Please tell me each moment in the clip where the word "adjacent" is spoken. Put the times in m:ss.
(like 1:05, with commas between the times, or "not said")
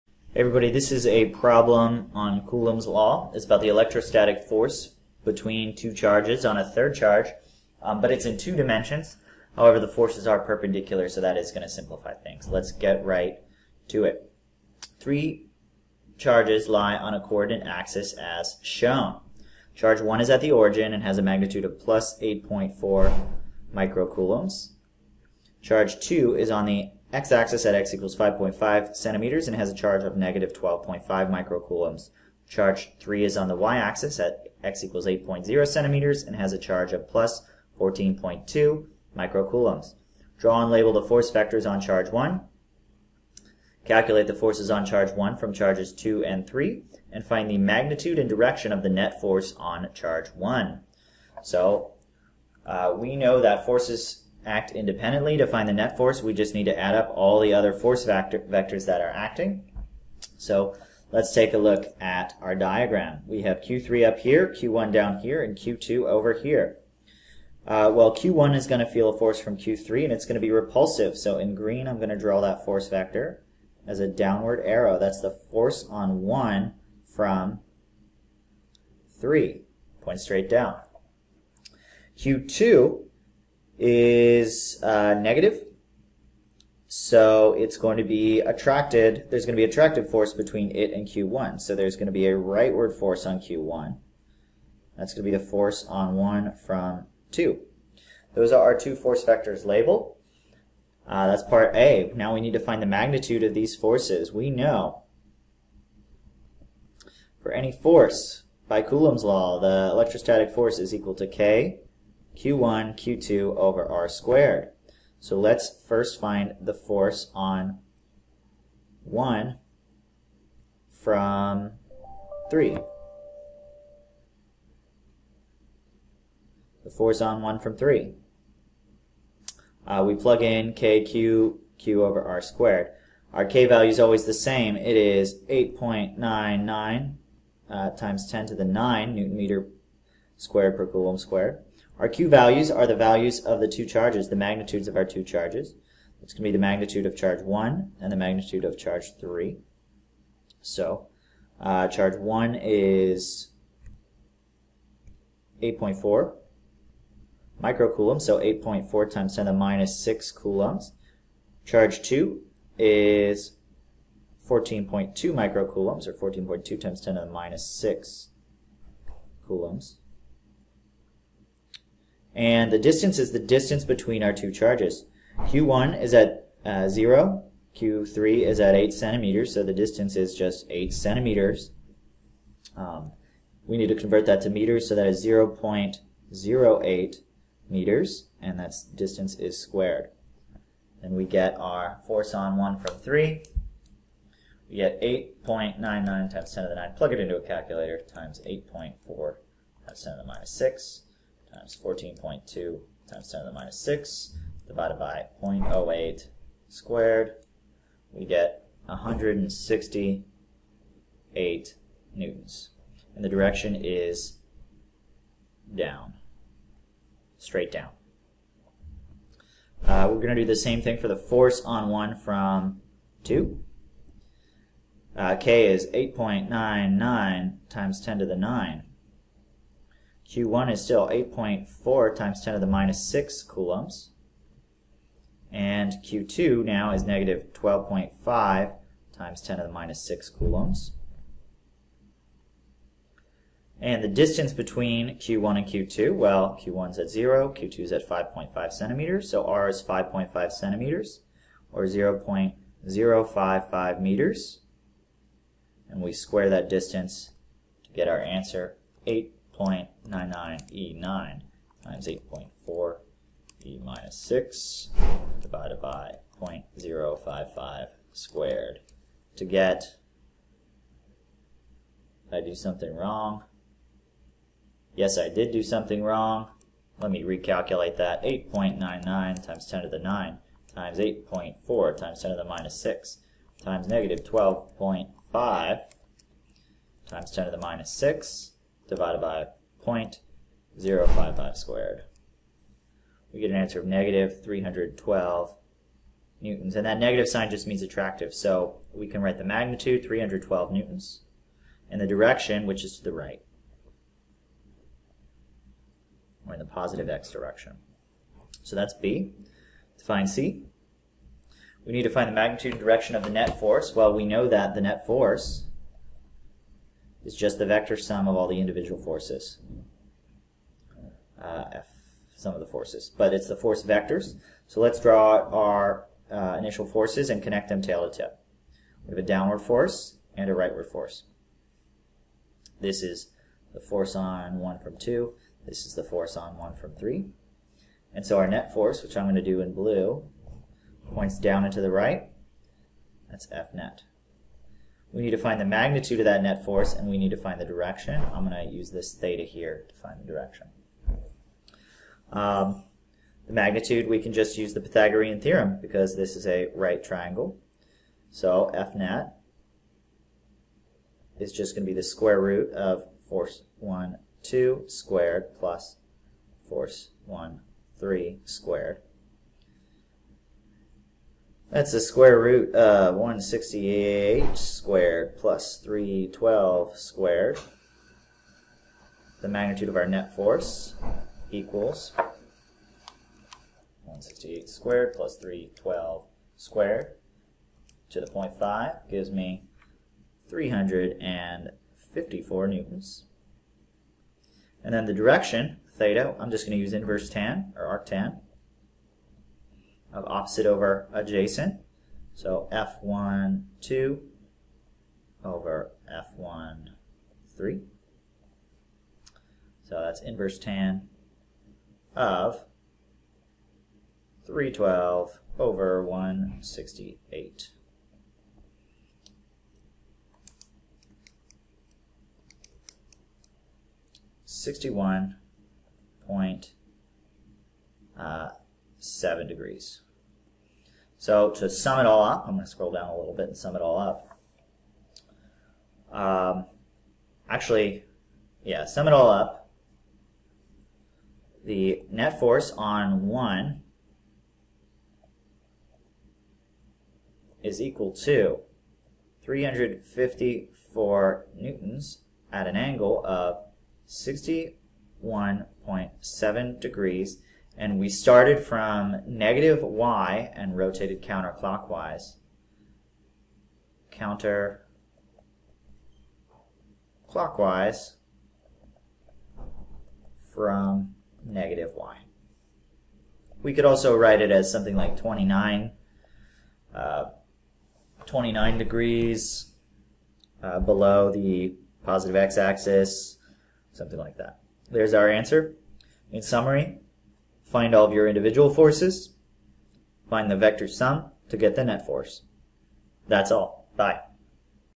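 6:41.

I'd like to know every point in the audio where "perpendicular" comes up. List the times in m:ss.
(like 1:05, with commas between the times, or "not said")
0:10.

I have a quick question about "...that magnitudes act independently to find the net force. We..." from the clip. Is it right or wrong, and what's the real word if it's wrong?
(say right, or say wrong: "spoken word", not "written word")
wrong: "forces", not "magnitudes".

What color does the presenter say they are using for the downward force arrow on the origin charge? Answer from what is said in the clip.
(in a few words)
green.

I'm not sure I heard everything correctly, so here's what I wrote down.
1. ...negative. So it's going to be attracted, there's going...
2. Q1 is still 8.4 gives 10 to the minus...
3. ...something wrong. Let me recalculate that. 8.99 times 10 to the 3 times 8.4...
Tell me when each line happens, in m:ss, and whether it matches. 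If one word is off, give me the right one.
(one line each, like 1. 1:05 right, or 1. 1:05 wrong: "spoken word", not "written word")
1. 1:25 right
2. 3:50 wrong: "times", not "gives"
3. 4:35 wrong: "9", not "3".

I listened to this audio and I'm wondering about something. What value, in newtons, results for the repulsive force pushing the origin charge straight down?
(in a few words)
168 newtons.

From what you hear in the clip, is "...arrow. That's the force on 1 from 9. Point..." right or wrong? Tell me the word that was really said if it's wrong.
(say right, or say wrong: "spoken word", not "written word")
wrong: "3", not "9".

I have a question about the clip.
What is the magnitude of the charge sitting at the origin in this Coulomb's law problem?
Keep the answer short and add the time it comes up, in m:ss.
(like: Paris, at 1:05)
+8.4 microcoulombs, at 0:21.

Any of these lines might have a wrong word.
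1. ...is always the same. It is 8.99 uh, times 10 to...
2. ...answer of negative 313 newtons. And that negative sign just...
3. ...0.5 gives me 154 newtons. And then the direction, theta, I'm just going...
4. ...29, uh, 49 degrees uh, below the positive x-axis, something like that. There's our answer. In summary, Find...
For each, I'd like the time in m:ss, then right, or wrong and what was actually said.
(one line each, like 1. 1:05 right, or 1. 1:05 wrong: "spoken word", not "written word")
1. 2:13 right
2. 4:53 wrong: "312", not "313"
3. 6:28 wrong: "354", not "154"
4. 7:55 wrong: "29", not "49".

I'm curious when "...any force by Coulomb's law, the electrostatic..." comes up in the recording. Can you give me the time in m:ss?
1:47.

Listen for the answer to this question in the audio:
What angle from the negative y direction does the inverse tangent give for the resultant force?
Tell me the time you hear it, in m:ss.
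7:04.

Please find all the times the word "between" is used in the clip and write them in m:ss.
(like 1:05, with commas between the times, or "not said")
0:05, 1:30, 2:53, 4:04.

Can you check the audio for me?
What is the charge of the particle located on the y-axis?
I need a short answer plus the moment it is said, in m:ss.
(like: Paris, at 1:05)
+14.2 microcoulombs, at 0:37.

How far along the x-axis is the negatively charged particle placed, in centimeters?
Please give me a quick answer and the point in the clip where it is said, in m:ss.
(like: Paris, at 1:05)
5.5 centimeters, at 0:27.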